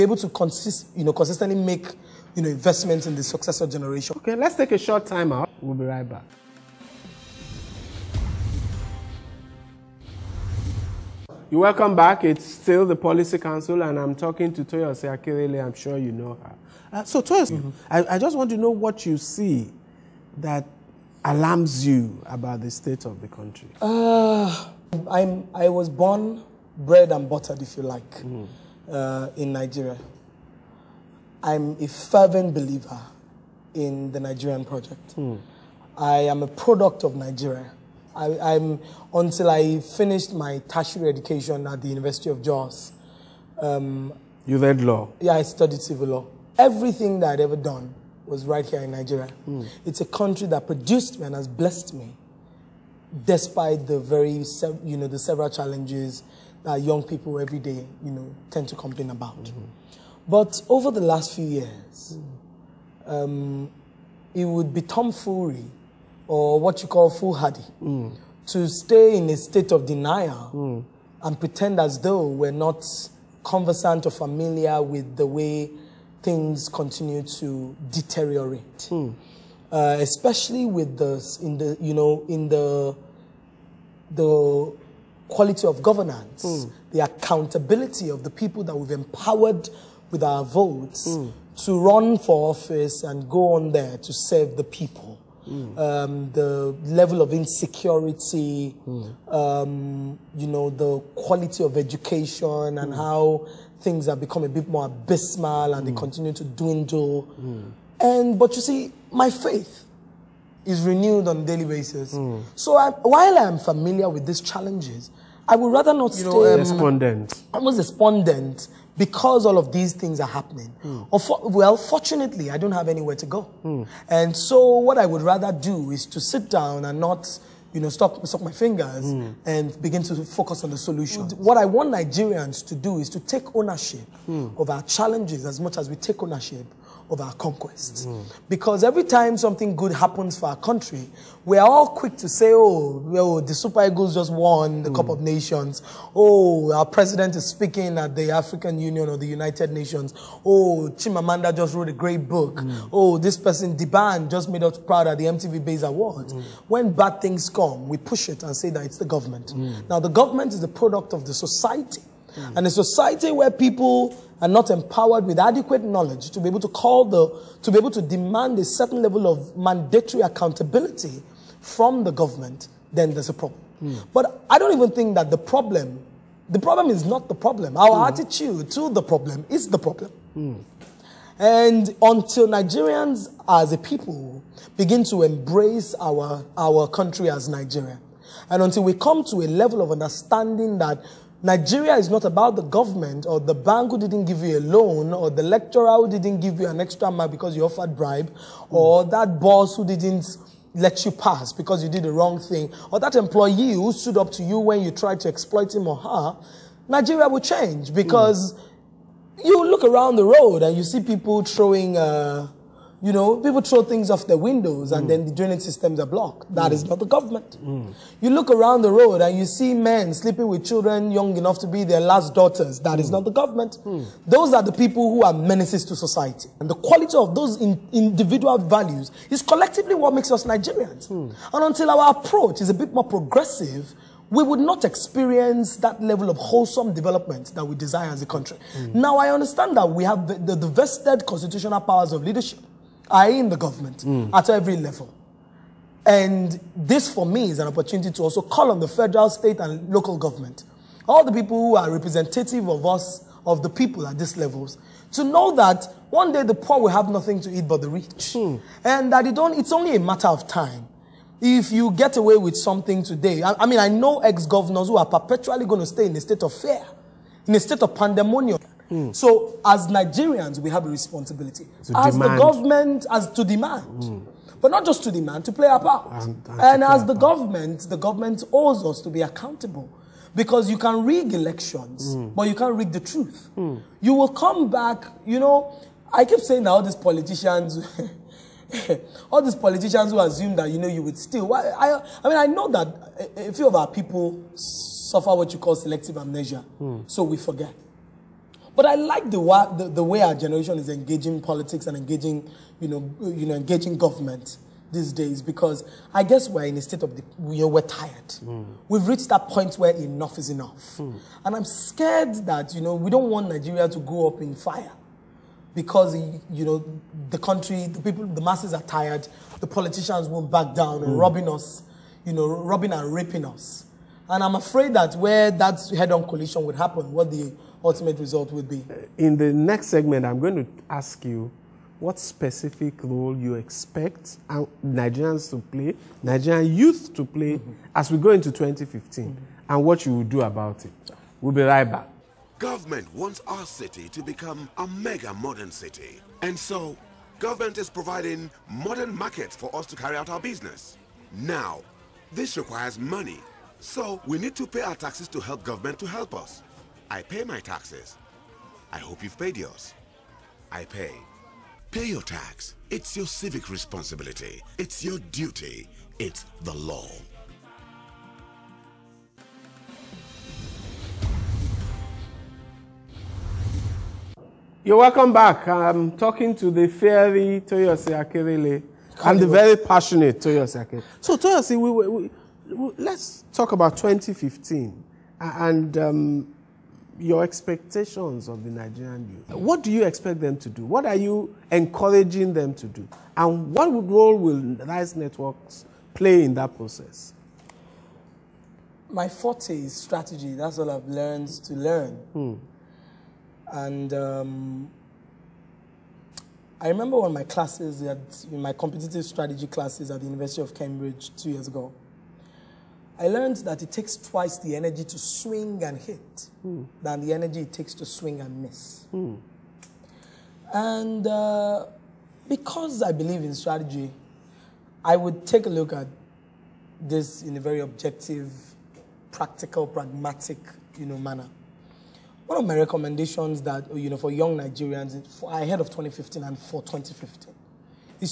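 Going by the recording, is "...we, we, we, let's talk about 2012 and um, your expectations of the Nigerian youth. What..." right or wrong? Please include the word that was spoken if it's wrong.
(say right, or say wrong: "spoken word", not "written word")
wrong: "2015", not "2012".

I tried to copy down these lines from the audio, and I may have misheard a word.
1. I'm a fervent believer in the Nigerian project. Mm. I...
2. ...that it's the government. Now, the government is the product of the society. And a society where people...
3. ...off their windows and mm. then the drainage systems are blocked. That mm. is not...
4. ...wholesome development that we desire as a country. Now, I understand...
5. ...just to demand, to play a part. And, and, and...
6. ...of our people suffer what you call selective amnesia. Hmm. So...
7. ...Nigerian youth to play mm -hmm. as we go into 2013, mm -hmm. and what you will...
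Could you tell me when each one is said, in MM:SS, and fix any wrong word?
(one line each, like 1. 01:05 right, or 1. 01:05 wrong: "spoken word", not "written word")
1. 00:31 right
2. 02:38 right
3. 03:34 right
4. 03:56 right
5. 04:34 right
6. 04:53 right
7. 05:36 wrong: "2015", not "2013".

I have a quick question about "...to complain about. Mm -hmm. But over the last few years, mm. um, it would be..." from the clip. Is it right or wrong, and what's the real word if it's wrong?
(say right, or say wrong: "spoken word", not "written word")
right.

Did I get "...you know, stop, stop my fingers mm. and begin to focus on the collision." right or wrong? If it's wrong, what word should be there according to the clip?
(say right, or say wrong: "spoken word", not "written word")
wrong: "solution", not "collision".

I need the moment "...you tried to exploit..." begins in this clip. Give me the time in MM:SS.
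03:24.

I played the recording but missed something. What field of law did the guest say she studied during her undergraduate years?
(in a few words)
Civil law.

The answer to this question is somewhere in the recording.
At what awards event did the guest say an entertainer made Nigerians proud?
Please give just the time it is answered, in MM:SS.
02:35.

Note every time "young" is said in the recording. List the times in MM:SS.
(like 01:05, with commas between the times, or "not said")
00:56, 03:41, 07:14.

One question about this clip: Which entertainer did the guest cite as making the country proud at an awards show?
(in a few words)
D'banj.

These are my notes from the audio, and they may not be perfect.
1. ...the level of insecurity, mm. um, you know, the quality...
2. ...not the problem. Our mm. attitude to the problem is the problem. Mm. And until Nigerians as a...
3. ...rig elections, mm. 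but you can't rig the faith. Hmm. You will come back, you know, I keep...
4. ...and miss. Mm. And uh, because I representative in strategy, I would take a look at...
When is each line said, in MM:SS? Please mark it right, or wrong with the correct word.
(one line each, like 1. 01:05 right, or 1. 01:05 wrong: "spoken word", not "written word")
1. 01:36 right
2. 02:57 right
3. 04:41 wrong: "truth", not "faith"
4. 06:58 wrong: "believe", not "representative".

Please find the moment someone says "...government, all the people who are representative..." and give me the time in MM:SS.
04:10.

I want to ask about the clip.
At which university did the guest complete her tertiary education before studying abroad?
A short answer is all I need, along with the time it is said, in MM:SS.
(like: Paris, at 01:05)
University of Jos, at 00:41.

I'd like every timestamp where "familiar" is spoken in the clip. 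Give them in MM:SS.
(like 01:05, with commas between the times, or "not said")
01:14, 01:53.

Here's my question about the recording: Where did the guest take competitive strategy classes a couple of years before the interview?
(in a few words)
University of Cambridge.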